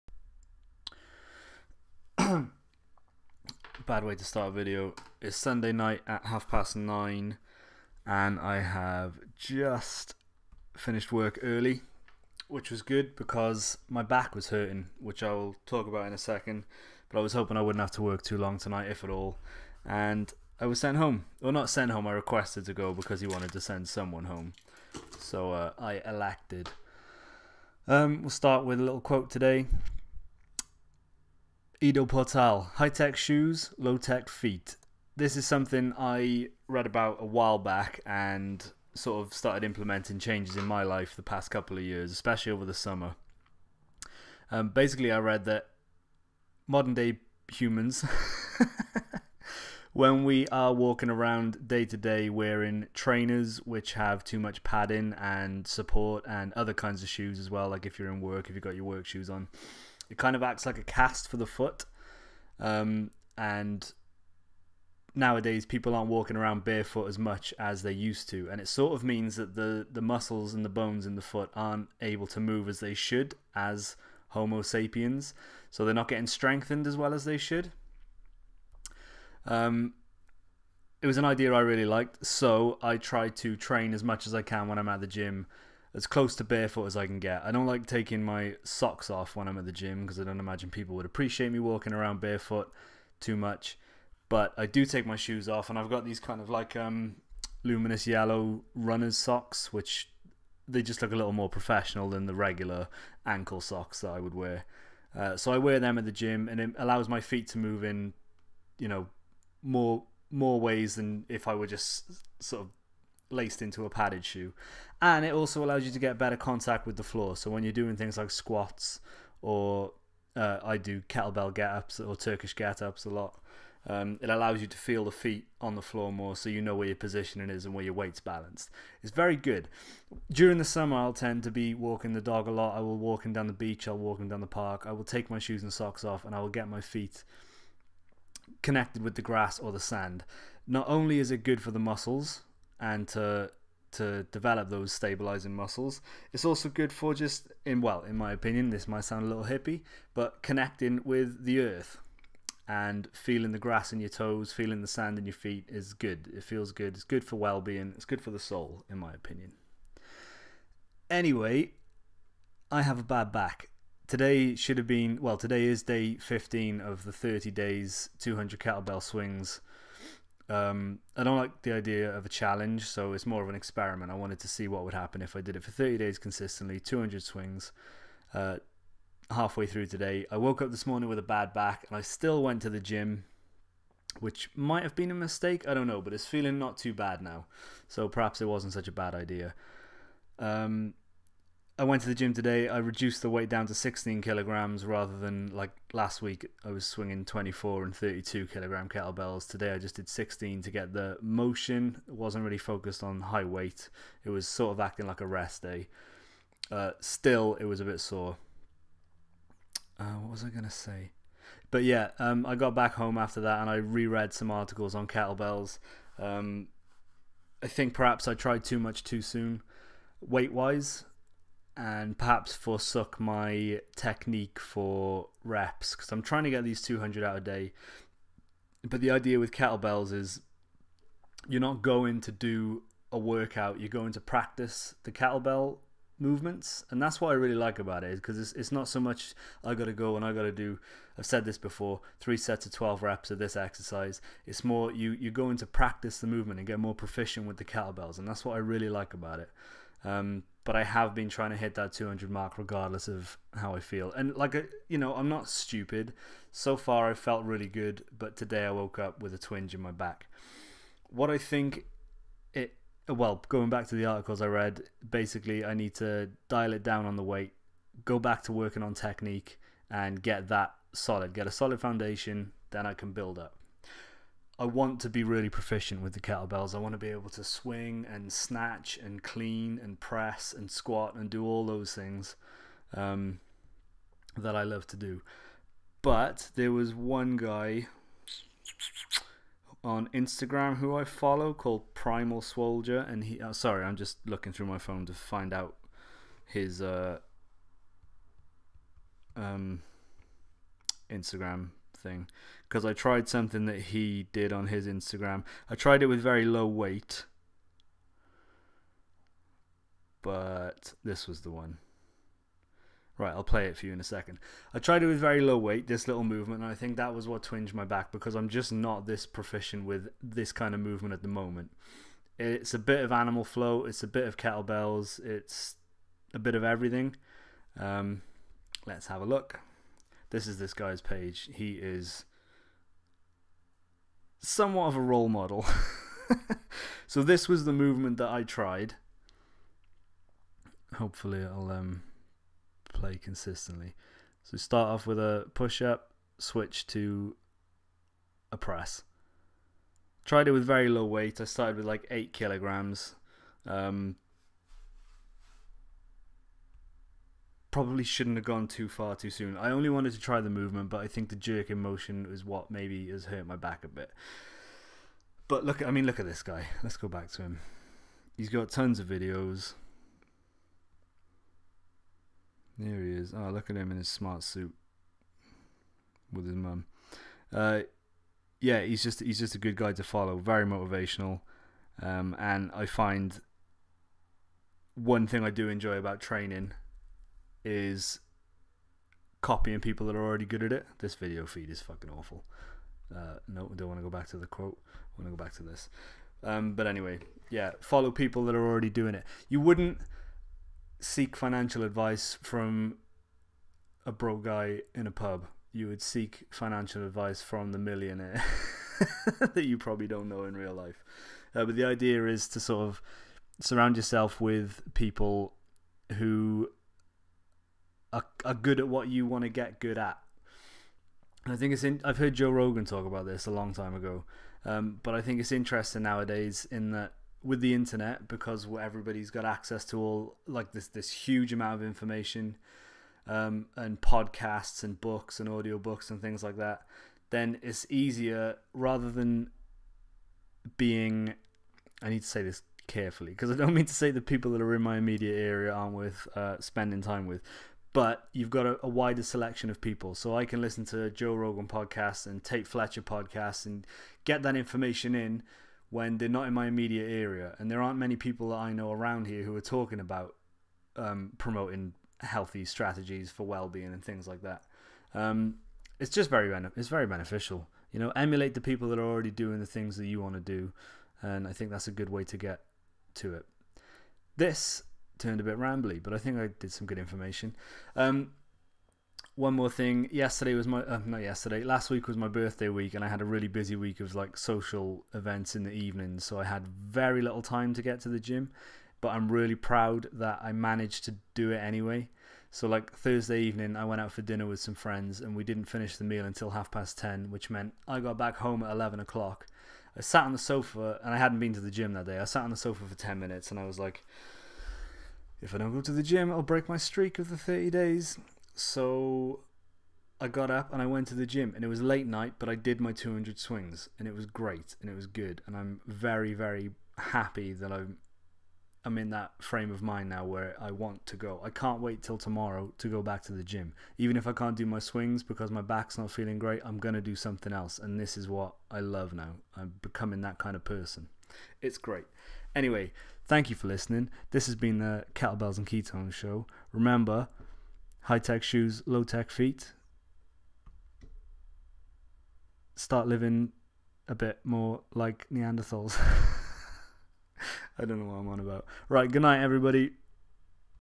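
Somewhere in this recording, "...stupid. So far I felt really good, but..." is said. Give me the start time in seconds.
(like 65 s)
255 s.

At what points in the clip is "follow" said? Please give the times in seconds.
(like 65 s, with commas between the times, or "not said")
291 s, 380 s, 397 s.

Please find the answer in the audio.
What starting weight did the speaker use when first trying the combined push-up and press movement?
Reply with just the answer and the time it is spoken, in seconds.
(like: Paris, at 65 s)
8 kilograms, at 352 s.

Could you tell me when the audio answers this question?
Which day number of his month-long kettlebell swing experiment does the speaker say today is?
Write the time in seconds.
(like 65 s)
165 s.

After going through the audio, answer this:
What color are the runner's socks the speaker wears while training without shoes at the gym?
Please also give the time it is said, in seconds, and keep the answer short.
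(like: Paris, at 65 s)
luminous yellow, at 97 s.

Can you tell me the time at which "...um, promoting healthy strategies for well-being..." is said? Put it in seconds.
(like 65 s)
460 s.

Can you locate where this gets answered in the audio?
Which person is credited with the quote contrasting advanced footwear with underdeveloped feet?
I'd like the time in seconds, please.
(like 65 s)
31 s.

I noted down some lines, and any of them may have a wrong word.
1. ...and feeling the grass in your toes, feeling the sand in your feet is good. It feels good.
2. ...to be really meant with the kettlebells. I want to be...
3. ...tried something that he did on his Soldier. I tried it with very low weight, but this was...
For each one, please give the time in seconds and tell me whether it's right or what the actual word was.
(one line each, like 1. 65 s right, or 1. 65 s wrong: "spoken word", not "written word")
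1. 152 s right
2. 274 s wrong: "proficient", not "meant"
3. 302 s wrong: "Instagram", not "Soldier".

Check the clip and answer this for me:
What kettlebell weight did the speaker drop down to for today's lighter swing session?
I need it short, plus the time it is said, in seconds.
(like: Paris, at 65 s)
16 kilograms, at 193 s.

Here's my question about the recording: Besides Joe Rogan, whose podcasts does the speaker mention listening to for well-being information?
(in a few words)
Tate Fletcher.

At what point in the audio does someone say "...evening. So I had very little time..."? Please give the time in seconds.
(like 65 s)
485 s.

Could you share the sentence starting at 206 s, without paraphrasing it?
Uh, still, it was a bit sore.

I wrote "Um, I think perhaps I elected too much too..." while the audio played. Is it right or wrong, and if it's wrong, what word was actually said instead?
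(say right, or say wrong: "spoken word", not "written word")
wrong: "tried", not "elected".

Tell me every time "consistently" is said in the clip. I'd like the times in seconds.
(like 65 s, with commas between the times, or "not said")
176 s, 343 s.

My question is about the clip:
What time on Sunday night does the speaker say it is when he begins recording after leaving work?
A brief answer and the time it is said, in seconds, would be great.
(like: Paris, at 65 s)
half past nine, at 6 s.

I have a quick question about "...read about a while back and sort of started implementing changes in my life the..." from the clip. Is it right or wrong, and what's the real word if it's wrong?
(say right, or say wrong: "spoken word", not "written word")
right.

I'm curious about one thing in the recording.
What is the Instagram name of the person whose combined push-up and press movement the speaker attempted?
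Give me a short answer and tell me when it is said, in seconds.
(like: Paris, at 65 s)
Primal Soldier, at 291 s.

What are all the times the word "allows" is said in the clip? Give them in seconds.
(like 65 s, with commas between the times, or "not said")
106 s, 115 s, 124 s.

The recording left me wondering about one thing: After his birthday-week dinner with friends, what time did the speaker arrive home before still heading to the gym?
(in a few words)
11 o'clock.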